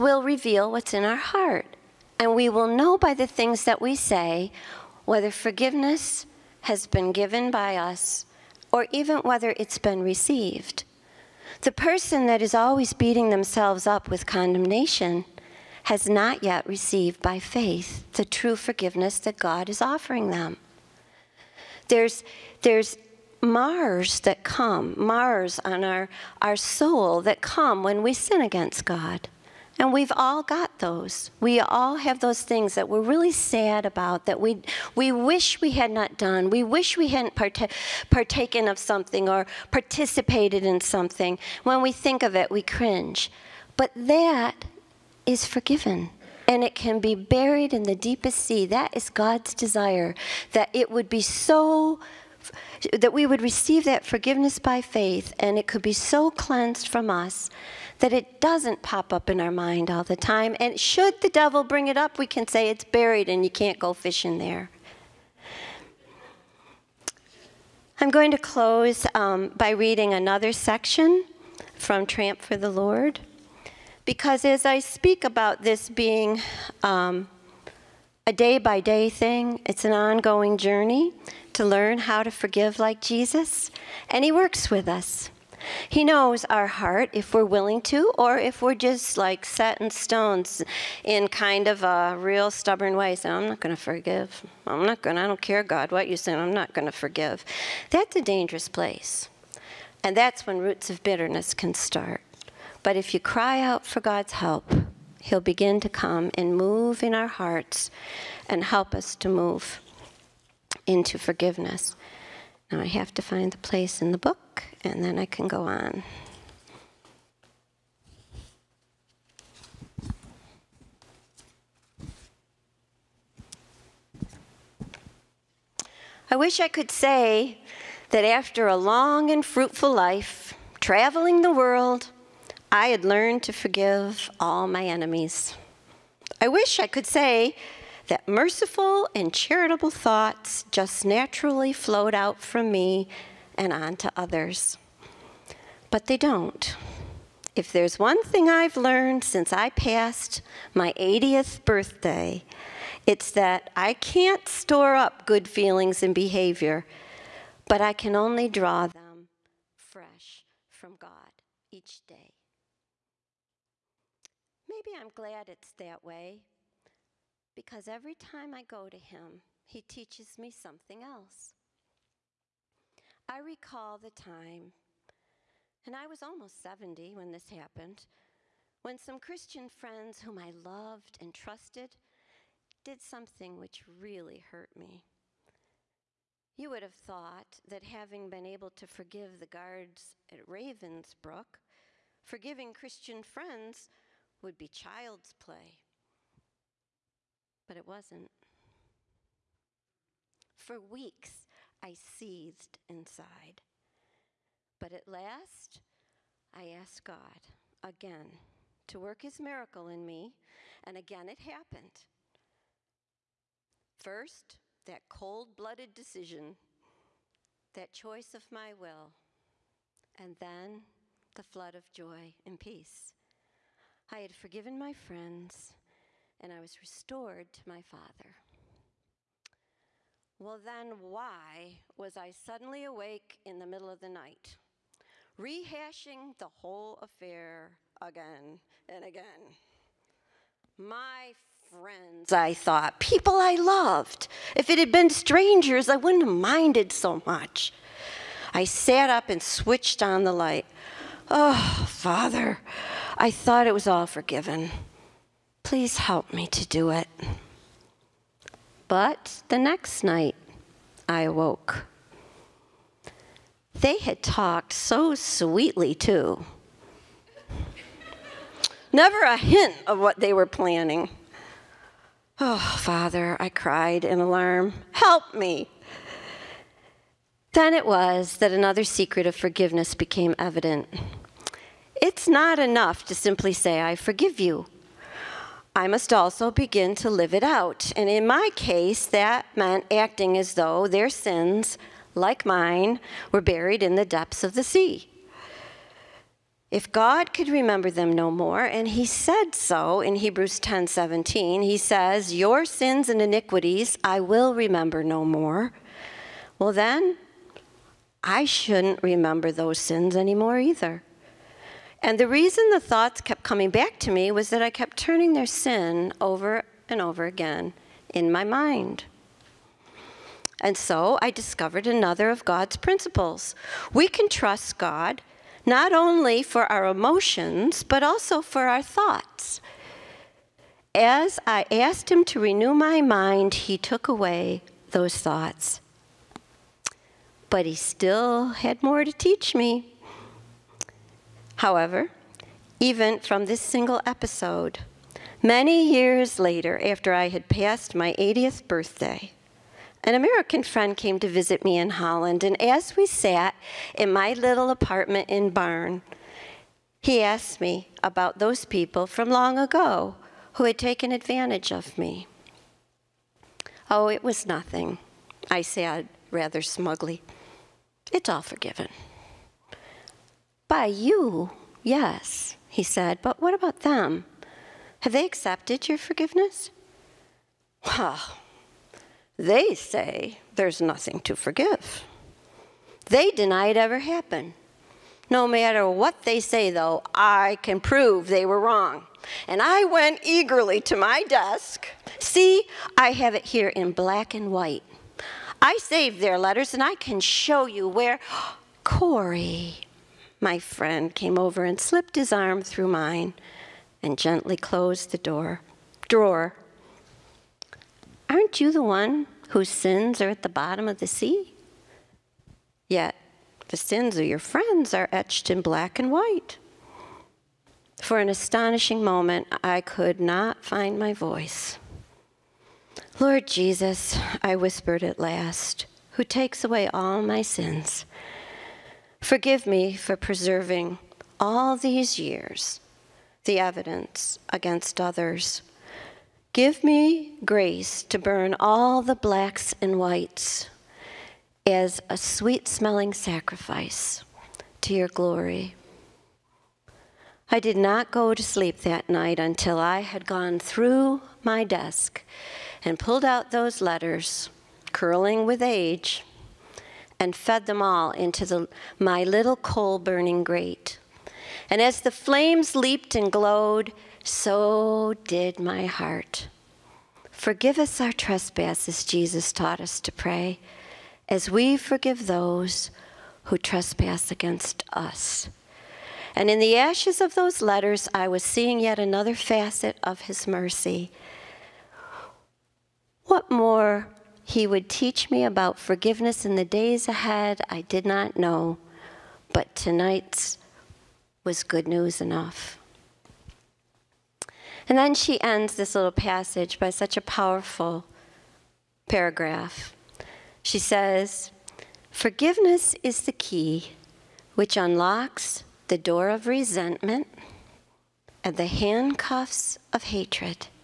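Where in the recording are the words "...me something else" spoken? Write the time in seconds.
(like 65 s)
170 s.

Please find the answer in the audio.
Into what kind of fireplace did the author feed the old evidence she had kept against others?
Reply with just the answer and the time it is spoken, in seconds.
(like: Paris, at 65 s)
Coal burning grate, at 459 s.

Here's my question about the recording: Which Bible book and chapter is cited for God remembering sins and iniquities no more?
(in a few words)
Hebrews 10.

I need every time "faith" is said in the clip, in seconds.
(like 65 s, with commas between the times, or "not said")
17 s, 54 s.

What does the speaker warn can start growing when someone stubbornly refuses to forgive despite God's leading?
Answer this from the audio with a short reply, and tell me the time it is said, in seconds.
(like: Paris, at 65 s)
Roots of bitterness, at 100 s.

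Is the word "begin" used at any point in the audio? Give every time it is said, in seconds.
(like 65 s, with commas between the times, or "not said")
105 s, 286 s.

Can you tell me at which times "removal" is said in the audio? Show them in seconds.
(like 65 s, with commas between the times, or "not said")
not said.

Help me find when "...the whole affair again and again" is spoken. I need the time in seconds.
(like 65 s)
236 s.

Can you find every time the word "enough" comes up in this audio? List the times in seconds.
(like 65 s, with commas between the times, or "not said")
282 s, 492 s.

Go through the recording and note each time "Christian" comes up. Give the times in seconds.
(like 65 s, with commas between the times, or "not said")
179 s, 192 s.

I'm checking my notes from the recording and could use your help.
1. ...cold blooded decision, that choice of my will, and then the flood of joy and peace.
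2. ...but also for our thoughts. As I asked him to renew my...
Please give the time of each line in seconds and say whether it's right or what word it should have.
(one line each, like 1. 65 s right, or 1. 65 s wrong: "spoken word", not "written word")
1. 215 s right
2. 327 s right.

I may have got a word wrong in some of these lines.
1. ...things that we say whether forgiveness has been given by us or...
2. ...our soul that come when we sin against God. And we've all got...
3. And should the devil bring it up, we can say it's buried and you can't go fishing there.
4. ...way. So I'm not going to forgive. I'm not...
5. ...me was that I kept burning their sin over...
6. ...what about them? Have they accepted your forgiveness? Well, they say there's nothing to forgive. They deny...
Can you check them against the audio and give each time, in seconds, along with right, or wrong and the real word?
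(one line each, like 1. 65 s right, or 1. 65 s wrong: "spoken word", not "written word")
1. 3 s right
2. 26 s right
3. 60 s right
4. 92 s right
5. 314 s wrong: "turning", not "burning"
6. 373 s right.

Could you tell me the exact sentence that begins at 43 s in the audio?
But that is forgiven and it can be buried in the deepest sea.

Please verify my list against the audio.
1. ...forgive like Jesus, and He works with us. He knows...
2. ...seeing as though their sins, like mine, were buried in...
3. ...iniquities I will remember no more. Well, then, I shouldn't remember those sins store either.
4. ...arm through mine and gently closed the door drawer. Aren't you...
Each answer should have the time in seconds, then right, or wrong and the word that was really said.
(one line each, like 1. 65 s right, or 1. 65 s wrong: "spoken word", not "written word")
1. 82 s right
2. 289 s wrong: "acting", not "seeing"
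3. 303 s wrong: "anymore", not "store"
4. 402 s right.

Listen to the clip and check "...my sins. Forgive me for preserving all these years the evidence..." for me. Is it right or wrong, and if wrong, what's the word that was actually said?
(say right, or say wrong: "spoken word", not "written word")
right.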